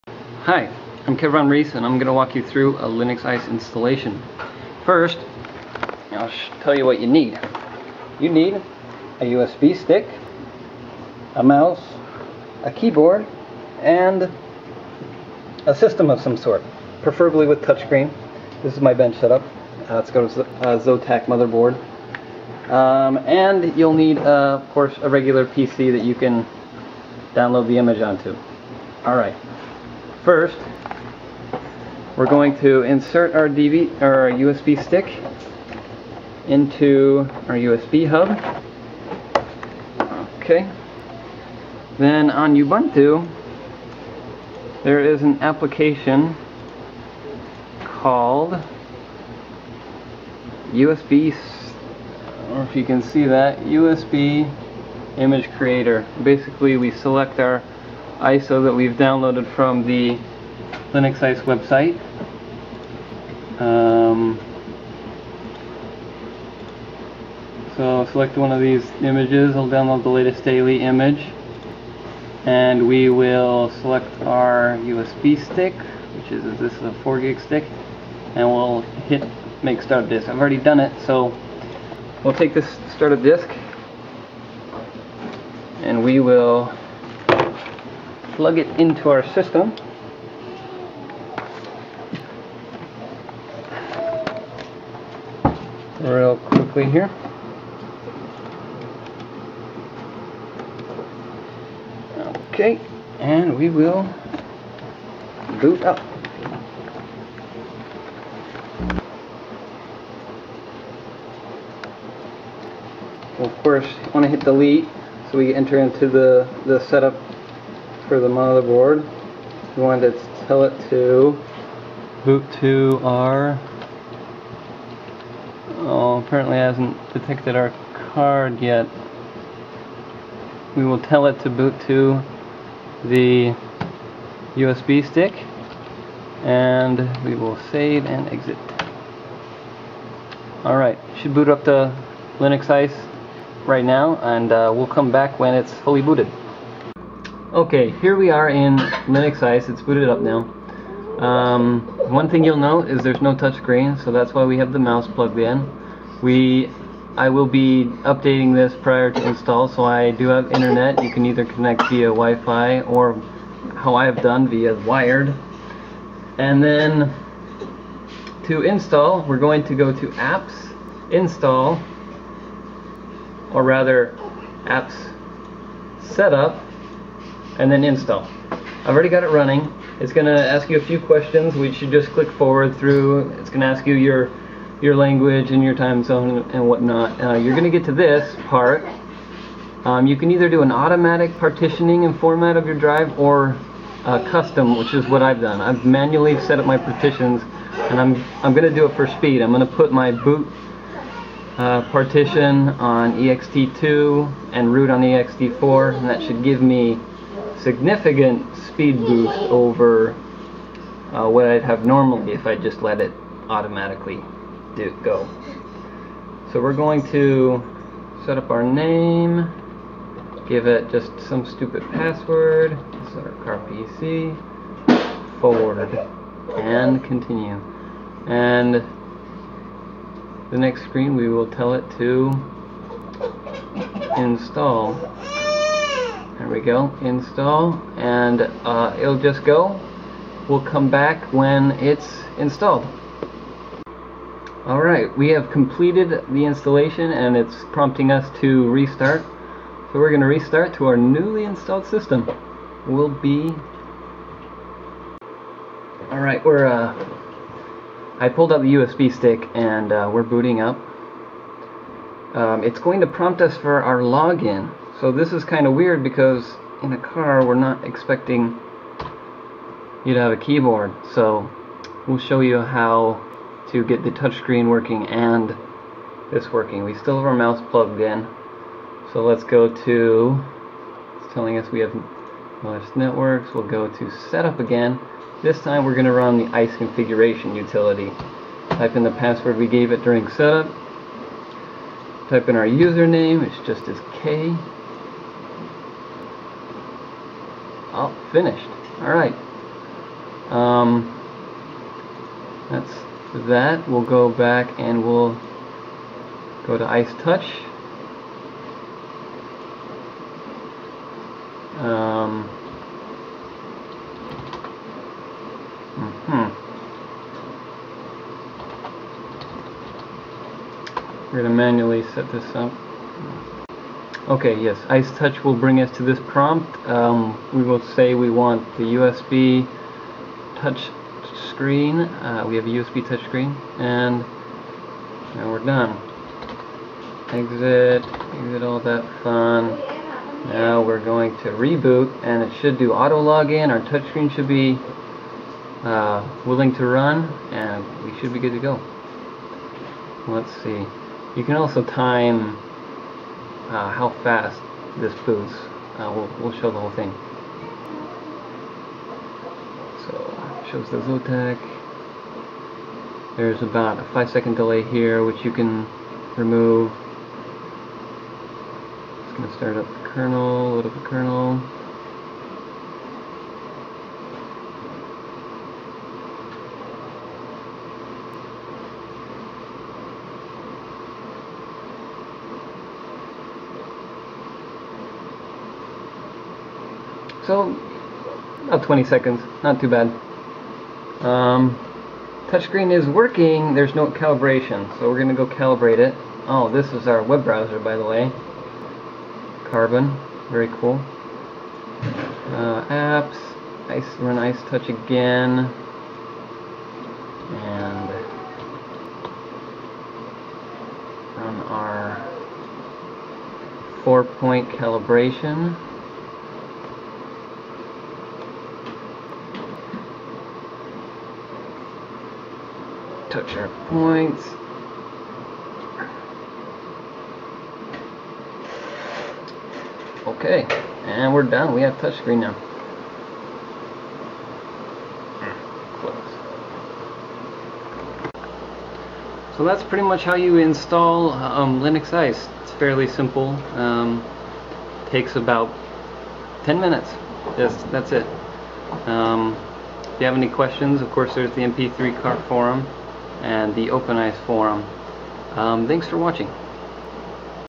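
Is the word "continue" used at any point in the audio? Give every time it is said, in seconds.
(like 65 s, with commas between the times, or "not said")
227 s.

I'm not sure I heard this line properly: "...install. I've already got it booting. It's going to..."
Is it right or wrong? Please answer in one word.
wrong.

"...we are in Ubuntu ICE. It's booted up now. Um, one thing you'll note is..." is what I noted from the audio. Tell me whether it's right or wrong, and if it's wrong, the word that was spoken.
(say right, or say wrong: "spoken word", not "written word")
wrong: "Linux", not "Ubuntu".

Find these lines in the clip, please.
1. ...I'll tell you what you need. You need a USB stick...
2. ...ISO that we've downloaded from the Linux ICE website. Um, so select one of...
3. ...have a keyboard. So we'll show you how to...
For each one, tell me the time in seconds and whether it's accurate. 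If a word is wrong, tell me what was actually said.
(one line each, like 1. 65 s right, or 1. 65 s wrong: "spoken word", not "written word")
1. 6 s right
2. 58 s right
3. 270 s right.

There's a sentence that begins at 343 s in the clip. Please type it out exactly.
Our touch screen should be uh, willing to run, and we should be good to go.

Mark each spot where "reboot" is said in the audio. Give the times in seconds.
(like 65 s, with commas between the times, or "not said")
341 s.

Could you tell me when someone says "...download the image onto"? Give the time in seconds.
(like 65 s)
27 s.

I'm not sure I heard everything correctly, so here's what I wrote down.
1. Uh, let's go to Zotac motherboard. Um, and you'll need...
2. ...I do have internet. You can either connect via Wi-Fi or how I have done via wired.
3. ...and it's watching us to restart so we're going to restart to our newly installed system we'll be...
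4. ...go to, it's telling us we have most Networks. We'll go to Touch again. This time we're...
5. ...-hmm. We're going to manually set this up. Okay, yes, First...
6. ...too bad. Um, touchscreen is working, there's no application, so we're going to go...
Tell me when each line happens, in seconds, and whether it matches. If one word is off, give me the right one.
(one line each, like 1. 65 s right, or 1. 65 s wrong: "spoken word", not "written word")
1. 19 s right
2. 159 s right
3. 247 s wrong: "prompting", not "watching"
4. 279 s wrong: "Setup", not "Touch"
5. 316 s wrong: "Ice", not "First"
6. 389 s wrong: "calibration", not "application".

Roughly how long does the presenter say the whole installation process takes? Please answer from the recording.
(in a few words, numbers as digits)
10 minutes.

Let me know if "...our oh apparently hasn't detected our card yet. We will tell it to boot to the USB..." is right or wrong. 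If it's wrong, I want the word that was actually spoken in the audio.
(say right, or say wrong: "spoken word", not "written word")
right.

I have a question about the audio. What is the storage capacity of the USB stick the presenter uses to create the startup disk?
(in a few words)
4 GB.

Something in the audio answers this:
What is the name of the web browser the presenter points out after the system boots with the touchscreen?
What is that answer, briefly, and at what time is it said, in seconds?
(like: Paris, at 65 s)
Carbon, at 399 s.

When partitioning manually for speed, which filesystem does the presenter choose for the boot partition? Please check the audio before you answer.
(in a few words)
ext2.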